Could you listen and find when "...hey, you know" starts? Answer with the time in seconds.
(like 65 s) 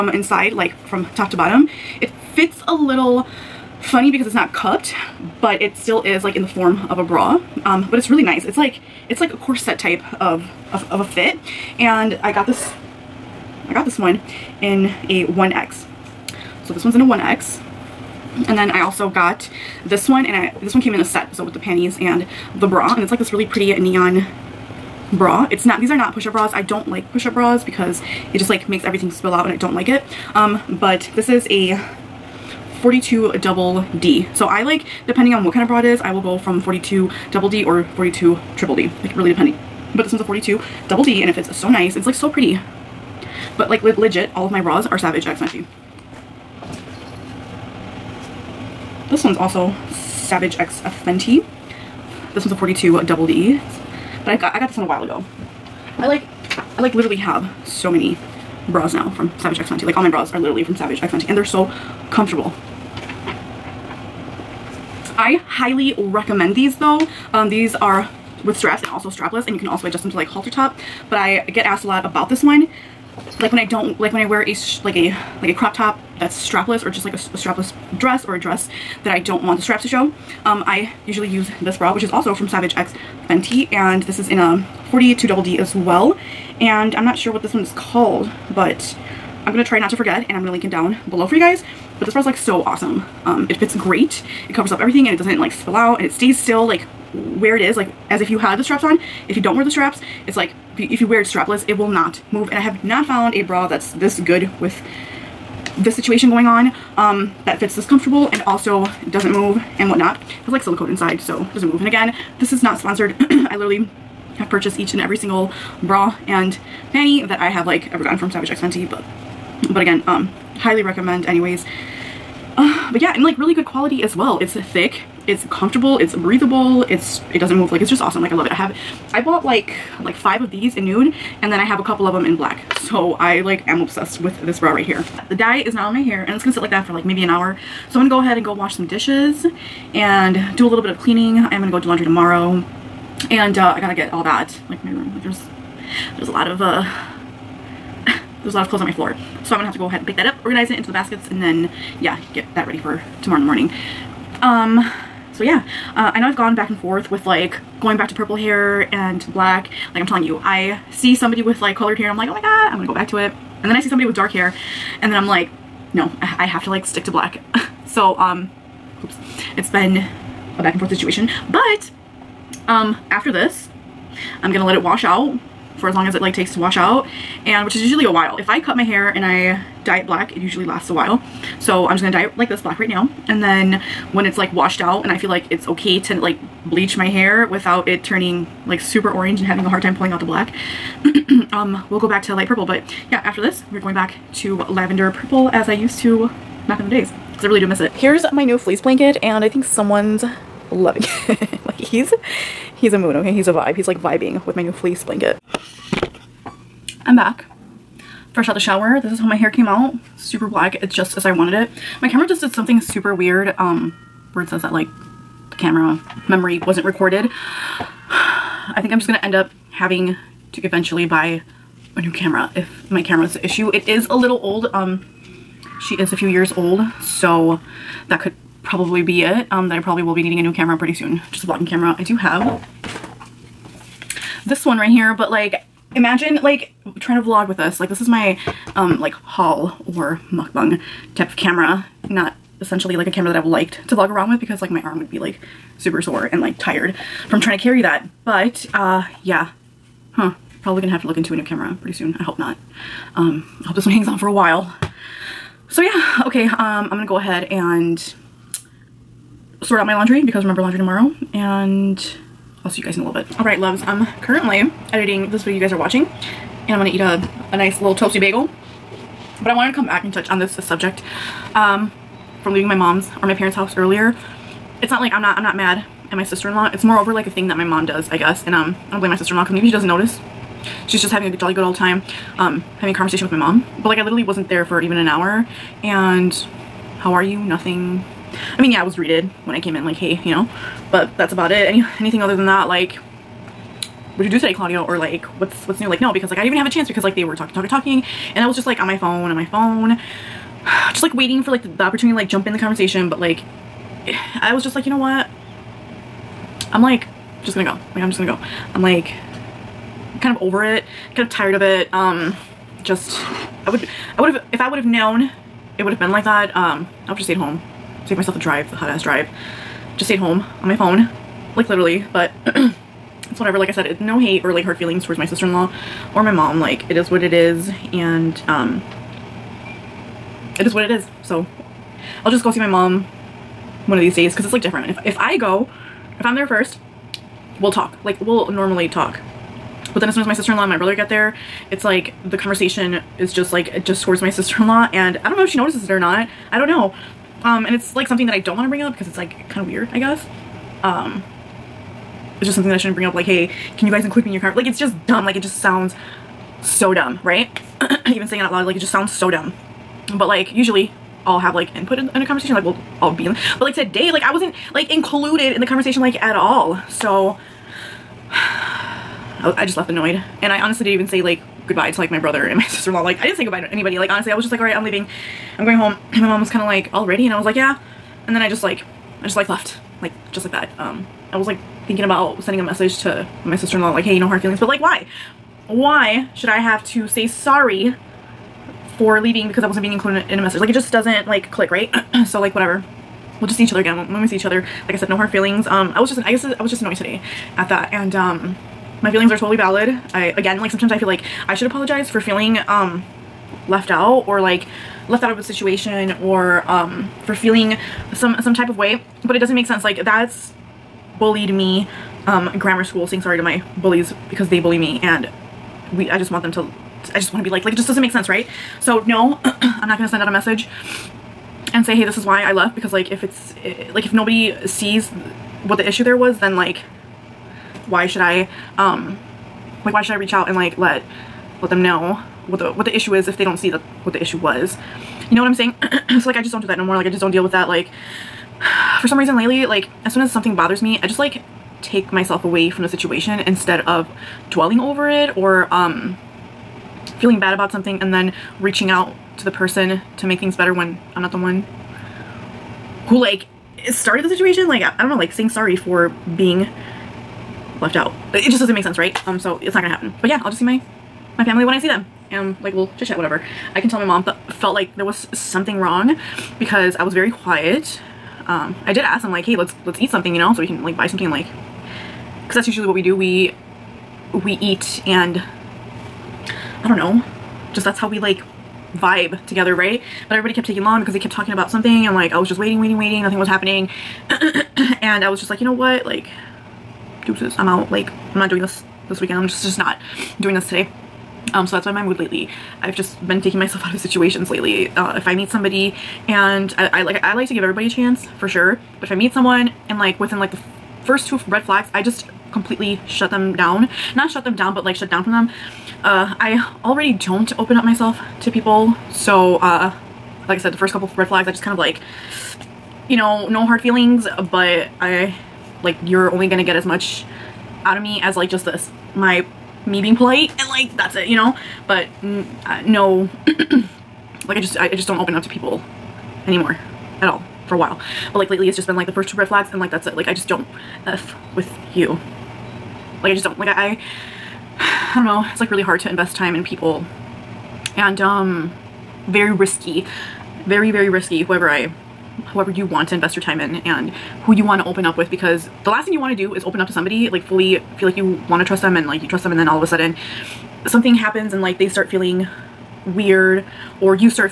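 289 s.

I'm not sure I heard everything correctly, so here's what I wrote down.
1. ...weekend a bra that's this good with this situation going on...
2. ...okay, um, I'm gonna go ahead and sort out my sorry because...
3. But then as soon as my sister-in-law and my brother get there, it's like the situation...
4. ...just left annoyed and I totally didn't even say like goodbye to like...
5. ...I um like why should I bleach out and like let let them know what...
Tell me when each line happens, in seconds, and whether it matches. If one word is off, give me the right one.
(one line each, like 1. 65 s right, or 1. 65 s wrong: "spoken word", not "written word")
1. 103 s wrong: "found", not "weekend"
2. 256 s wrong: "laundry", not "sorry"
3. 339 s wrong: "conversation", not "situation"
4. 369 s wrong: "honestly", not "totally"
5. 428 s wrong: "reach", not "bleach".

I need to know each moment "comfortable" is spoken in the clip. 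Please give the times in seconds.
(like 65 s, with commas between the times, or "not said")
62 s, 107 s, 125 s.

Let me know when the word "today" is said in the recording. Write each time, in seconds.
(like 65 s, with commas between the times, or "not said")
294 s, 363 s, 396 s, 490 s.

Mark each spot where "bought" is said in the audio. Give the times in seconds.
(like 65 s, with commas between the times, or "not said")
129 s.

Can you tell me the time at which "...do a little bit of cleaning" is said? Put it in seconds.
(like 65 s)
140 s.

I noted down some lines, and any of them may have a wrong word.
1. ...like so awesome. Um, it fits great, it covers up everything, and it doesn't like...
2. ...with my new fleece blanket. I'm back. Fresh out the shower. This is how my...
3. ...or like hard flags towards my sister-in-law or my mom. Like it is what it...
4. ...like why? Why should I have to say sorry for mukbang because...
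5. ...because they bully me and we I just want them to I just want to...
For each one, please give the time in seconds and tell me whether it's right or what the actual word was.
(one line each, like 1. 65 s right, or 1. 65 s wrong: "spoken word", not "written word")
1. 92 s right
2. 204 s right
3. 324 s wrong: "feelings", not "flags"
4. 384 s wrong: "leaving", not "mukbang"
5. 414 s right.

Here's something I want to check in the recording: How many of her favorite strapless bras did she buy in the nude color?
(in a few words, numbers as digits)
5.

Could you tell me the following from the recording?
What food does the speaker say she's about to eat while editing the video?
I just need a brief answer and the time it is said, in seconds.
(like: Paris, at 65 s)
bagel, at 268 s.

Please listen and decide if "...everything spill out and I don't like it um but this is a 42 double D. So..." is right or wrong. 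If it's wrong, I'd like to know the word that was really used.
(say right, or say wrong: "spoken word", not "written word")
right.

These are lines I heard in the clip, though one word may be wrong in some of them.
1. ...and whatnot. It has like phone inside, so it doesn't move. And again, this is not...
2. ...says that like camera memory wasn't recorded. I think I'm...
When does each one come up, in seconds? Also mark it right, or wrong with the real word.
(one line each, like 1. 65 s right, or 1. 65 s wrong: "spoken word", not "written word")
1. 109 s wrong: "silicone", not "phone"
2. 214 s right.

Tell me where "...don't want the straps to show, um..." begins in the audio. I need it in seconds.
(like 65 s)
79 s.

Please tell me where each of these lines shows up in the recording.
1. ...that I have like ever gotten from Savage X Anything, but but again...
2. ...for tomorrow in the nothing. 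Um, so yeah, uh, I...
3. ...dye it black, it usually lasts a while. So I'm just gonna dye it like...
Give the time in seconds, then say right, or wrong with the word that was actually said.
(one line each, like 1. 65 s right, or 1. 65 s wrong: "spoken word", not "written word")
1. 117 s wrong: "Fenty", not "Anything"
2. 152 s wrong: "morning", not "nothing"
3. 179 s right.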